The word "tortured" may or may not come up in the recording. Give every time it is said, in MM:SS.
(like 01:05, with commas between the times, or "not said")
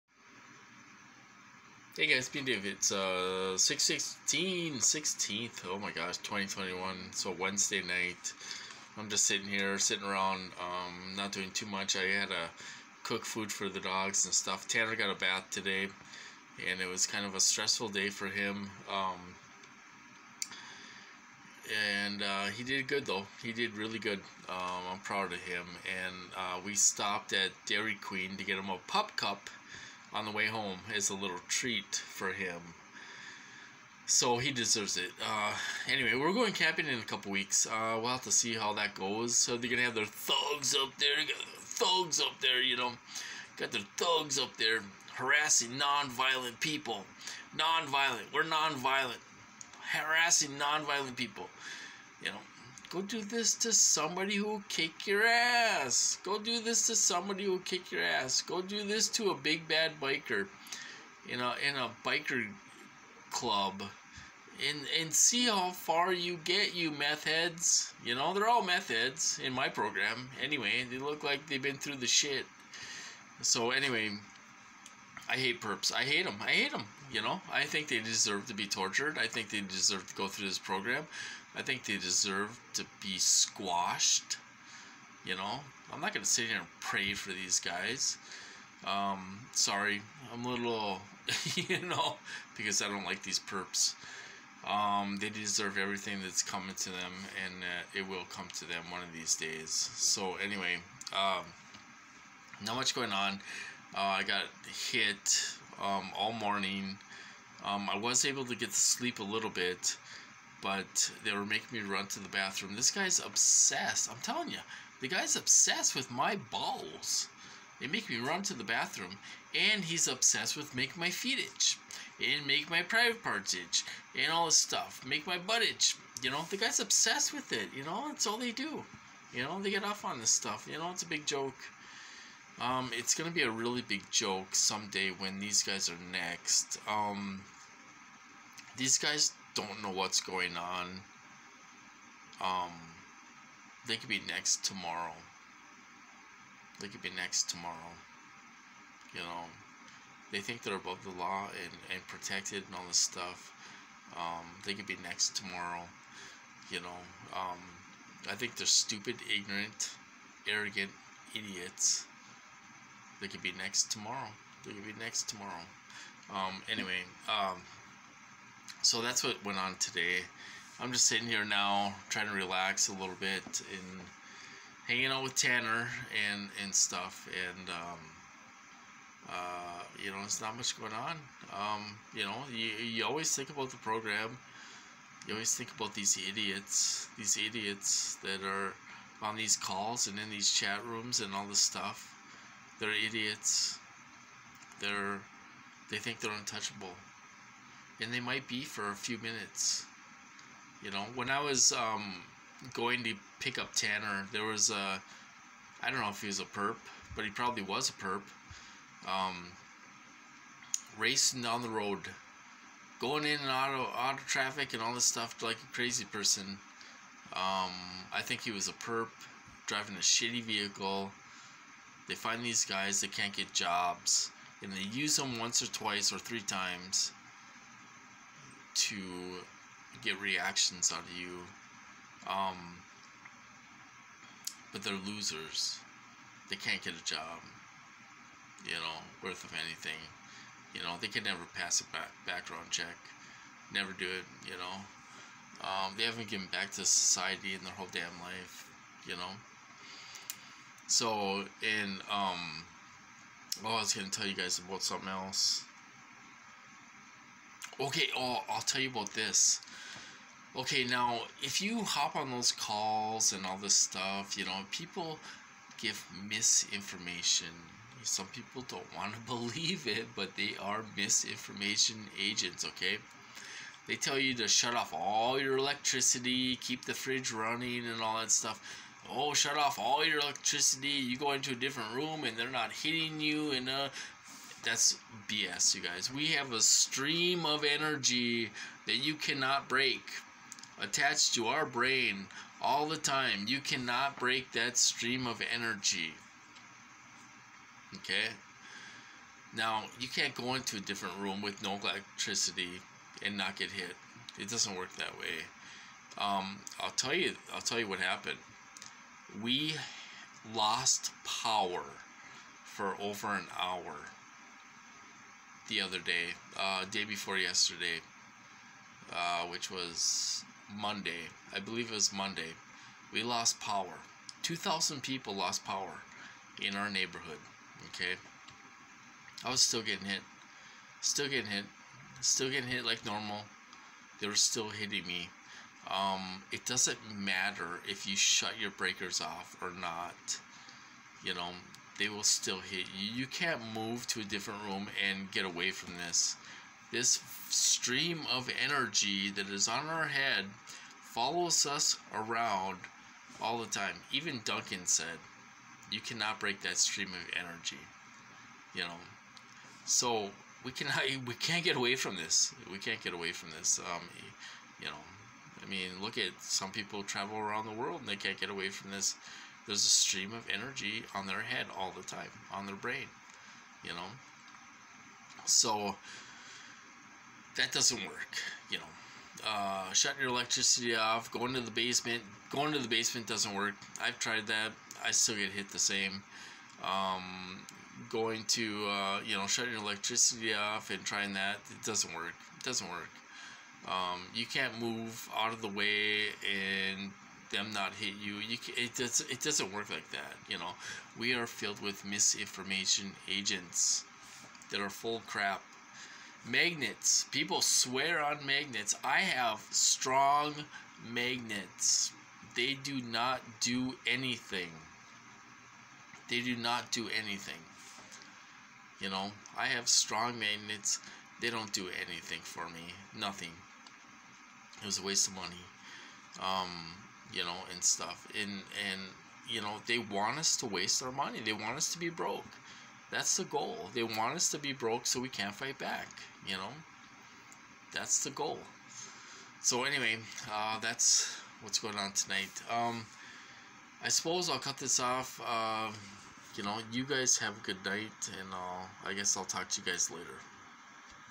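01:18.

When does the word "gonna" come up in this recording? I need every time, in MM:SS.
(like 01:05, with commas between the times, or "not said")
00:39, 02:13.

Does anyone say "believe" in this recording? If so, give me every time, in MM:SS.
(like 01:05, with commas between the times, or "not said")
04:29, 05:21.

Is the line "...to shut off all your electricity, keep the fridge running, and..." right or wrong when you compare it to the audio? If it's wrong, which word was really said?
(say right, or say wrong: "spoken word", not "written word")
right.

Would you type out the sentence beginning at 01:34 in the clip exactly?
Um, they deserve everything that's coming to them, and uh, it will come to them one of these days.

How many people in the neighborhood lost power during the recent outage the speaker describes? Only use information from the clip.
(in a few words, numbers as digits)
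2,000.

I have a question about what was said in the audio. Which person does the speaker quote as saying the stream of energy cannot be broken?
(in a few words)
Duncan.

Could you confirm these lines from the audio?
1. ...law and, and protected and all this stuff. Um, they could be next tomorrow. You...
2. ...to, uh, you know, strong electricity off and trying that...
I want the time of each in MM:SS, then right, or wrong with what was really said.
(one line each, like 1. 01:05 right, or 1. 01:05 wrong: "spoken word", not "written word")
1. 02:31 right
2. 06:28 wrong: "shutting", not "strong".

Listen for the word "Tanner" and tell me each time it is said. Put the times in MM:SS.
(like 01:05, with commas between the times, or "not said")
00:14, 02:55, 03:23.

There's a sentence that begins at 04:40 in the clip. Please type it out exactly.
You go into a different room and they're not hitting you.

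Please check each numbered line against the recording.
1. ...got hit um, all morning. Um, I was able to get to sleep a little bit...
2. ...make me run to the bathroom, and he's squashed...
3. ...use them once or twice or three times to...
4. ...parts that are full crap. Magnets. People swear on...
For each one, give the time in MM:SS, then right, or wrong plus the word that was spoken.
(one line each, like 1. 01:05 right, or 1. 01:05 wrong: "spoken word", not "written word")
1. 01:44 right
2. 01:57 wrong: "obsessed", not "squashed"
3. 03:44 right
4. 06:43 wrong: "agents", not "parts".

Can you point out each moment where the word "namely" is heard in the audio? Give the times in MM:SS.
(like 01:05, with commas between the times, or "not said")
not said.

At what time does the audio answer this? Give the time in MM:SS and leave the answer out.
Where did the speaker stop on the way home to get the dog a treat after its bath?
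00:27.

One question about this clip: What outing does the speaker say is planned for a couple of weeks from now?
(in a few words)
camping.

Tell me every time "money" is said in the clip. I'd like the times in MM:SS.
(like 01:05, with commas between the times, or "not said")
07:05, 07:11.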